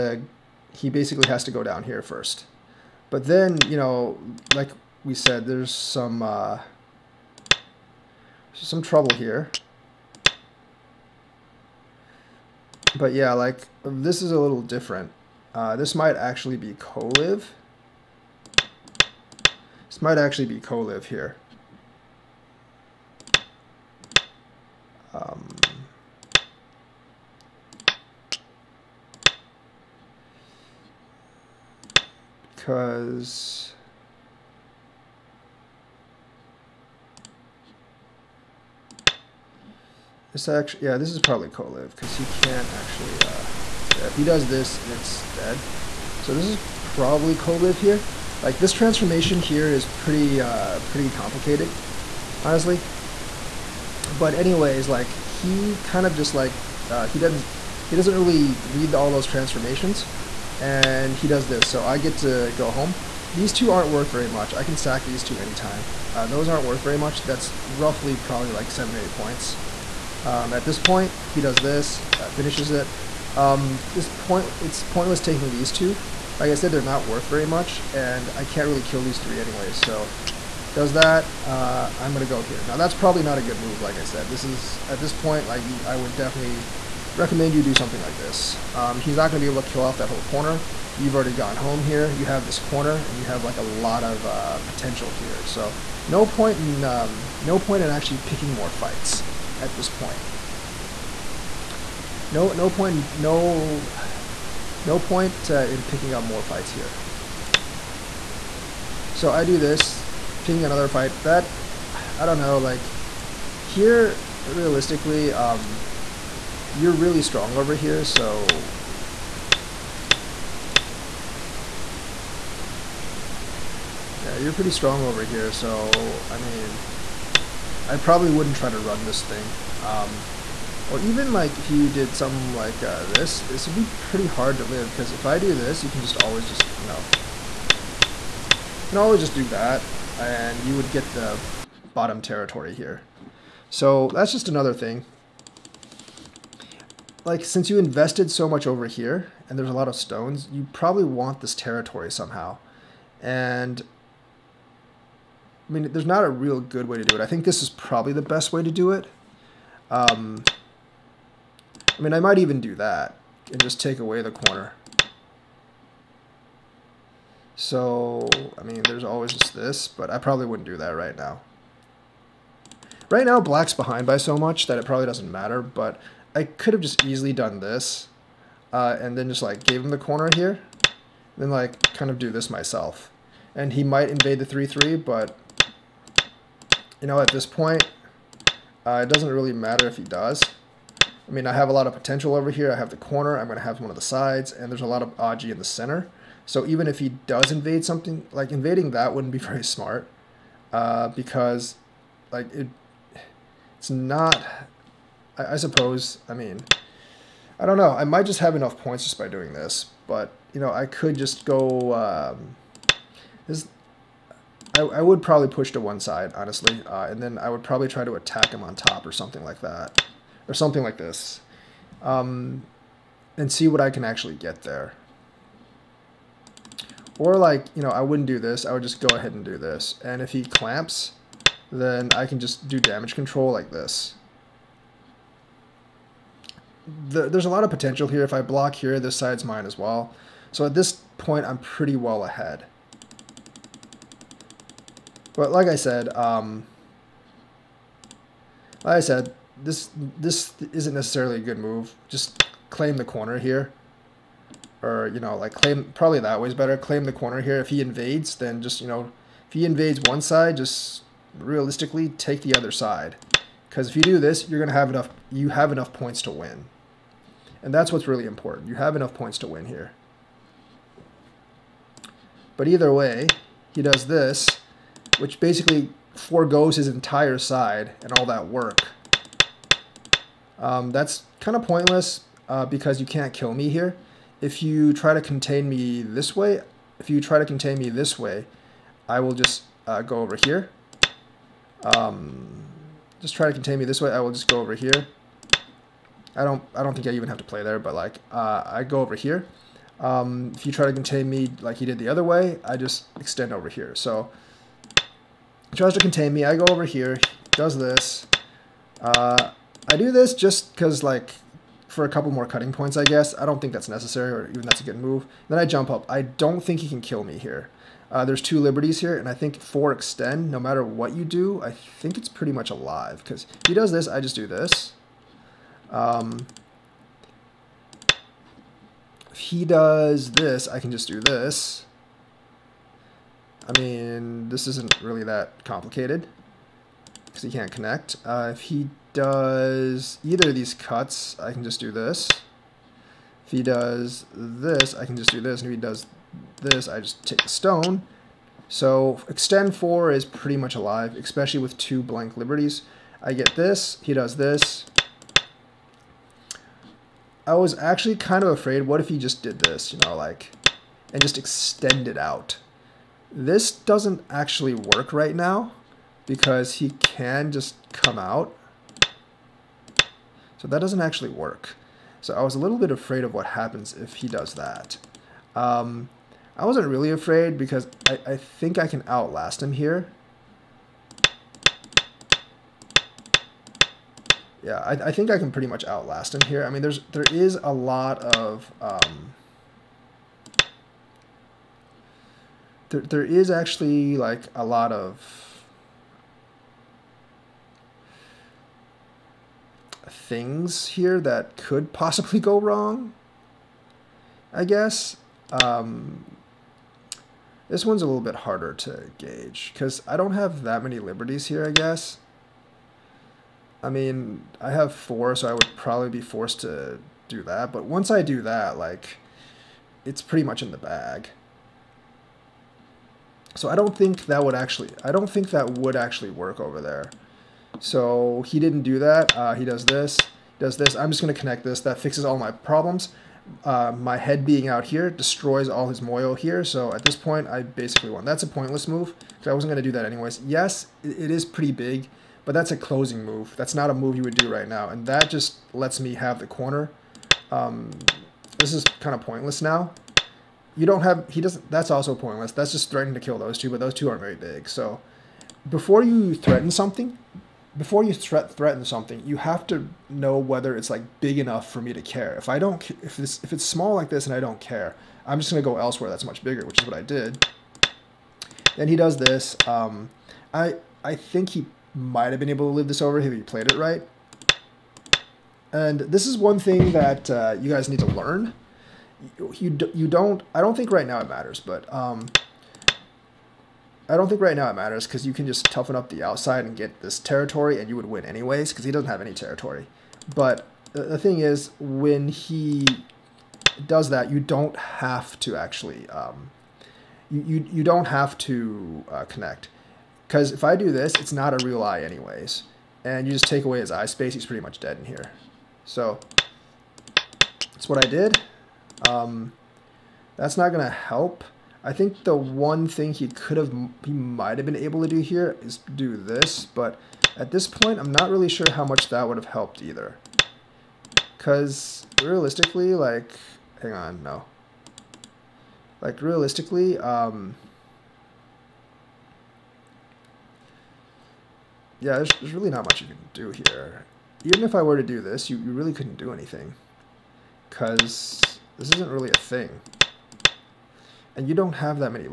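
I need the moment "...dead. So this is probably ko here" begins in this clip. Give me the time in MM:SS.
00:45.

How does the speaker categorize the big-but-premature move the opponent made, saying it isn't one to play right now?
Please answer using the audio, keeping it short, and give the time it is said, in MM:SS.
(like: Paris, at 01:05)
a closing move, at 07:22.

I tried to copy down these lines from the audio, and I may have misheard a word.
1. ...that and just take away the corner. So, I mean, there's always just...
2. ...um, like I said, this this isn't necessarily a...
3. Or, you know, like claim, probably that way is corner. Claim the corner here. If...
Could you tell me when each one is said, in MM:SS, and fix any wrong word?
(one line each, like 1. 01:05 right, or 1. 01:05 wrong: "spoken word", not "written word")
1. 02:42 right
2. 04:06 right
3. 04:14 wrong: "better", not "corner".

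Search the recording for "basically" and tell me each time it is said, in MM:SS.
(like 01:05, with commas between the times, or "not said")
00:00, 04:35, 07:17.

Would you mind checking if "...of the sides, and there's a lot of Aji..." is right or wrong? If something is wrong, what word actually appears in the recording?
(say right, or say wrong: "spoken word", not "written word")
right.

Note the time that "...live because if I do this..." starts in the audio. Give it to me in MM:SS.
02:14.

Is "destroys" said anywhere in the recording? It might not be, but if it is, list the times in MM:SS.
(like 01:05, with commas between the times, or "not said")
07:15.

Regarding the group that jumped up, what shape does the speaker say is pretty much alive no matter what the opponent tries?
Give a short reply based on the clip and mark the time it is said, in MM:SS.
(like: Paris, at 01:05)
extend 4, at 05:49.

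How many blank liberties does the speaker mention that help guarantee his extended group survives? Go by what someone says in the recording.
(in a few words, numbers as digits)
2.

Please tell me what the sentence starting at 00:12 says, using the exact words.
But yeah, like this is a little different.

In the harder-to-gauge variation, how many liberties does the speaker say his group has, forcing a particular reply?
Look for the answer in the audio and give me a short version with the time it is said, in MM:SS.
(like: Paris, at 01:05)
4, at 06:54.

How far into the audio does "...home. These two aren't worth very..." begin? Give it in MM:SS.
01:02.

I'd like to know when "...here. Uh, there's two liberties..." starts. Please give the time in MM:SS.
05:17.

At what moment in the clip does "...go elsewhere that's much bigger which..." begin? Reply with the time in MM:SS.
07:45.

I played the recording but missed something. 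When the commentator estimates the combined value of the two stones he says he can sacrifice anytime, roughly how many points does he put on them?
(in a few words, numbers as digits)
7 or 8.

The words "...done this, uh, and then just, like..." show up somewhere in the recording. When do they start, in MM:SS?
02:57.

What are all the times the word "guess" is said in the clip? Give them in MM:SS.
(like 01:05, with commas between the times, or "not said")
05:13, 06:44, 06:51.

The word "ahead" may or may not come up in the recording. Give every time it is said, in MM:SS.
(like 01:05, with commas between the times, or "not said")
03:49, 04:02.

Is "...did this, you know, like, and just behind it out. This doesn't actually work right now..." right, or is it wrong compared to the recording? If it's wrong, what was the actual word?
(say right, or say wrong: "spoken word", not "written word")
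wrong: "extend", not "behind".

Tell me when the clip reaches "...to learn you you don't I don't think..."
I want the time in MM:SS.
07:57.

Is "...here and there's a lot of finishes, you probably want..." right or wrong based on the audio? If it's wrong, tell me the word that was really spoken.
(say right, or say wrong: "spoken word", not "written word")
wrong: "stones", not "finishes".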